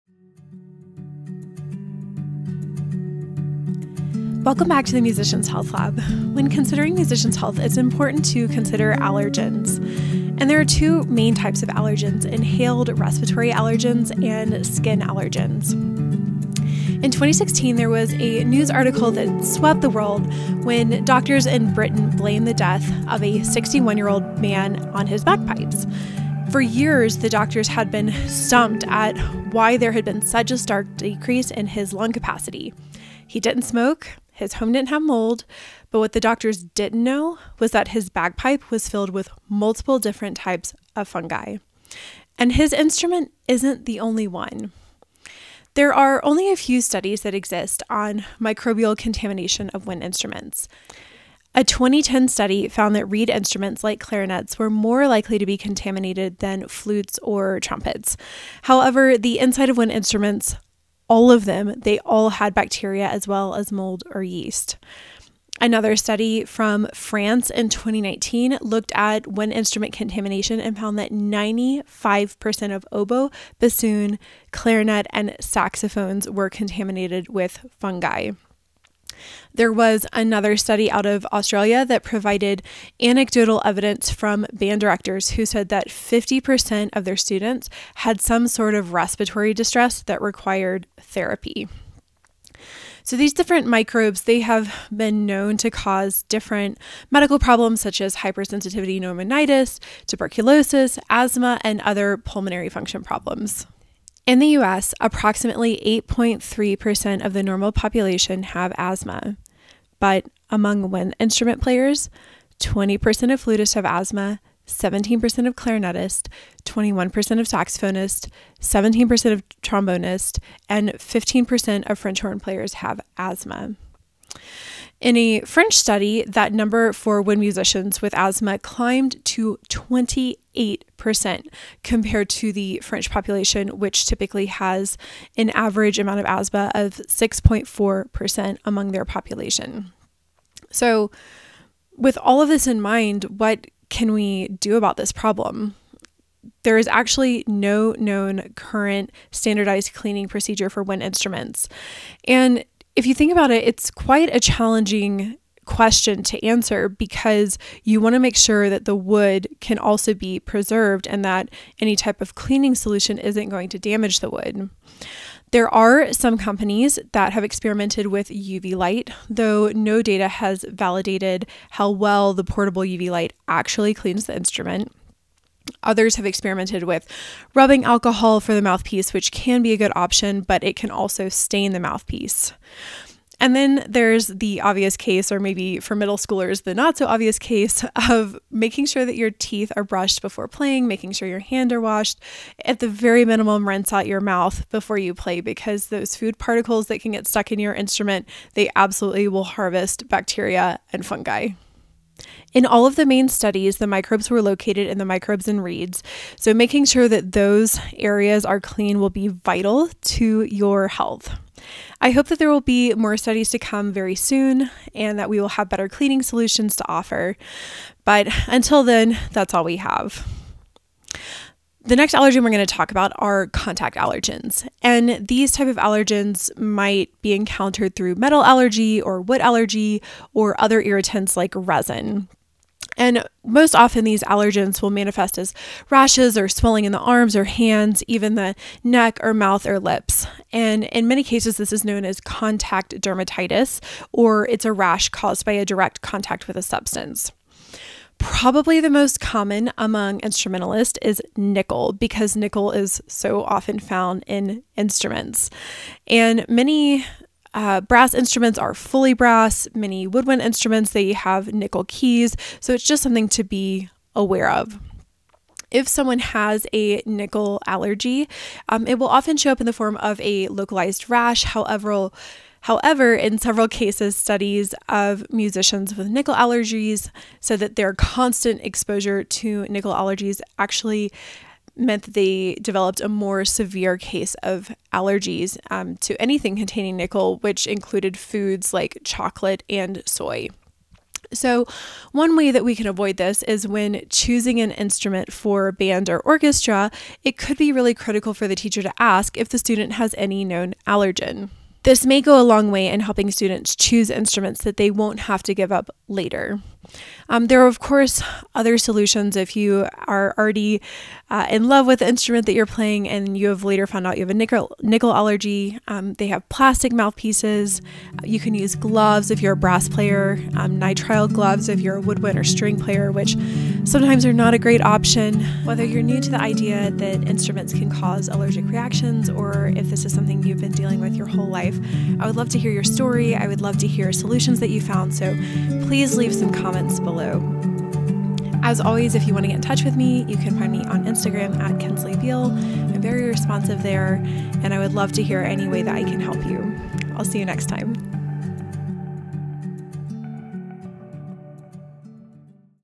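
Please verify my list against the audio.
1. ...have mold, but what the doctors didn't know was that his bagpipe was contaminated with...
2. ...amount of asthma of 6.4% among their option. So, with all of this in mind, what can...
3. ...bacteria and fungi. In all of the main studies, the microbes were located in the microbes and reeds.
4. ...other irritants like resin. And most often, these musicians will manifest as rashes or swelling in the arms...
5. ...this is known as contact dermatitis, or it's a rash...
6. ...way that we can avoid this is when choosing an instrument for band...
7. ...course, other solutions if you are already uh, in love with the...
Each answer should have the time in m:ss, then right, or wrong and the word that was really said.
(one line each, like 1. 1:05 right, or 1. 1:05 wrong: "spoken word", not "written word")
1. 0:34 wrong: "filled", not "contaminated"
2. 2:15 wrong: "population", not "option"
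3. 3:20 right
4. 3:50 wrong: "allergens", not "musicians"
5. 4:01 right
6. 4:52 right
7. 5:07 right.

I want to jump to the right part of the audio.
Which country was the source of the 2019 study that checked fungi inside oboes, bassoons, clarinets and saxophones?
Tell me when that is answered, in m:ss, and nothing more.
1:06.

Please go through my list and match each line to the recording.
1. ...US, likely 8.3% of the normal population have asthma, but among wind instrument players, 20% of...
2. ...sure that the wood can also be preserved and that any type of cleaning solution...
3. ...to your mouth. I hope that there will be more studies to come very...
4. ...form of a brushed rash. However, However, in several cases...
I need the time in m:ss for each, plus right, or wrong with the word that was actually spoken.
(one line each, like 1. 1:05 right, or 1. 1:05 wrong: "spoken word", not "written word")
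1. 1:44 wrong: "approximately", not "likely"
2. 2:38 right
3. 3:29 wrong: "health", not "mouth"
4. 4:29 wrong: "localized", not "brushed".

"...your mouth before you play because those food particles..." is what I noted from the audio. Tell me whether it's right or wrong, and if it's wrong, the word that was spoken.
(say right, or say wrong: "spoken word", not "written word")
right.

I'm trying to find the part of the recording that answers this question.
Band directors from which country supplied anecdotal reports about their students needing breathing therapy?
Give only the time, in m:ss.
1:21.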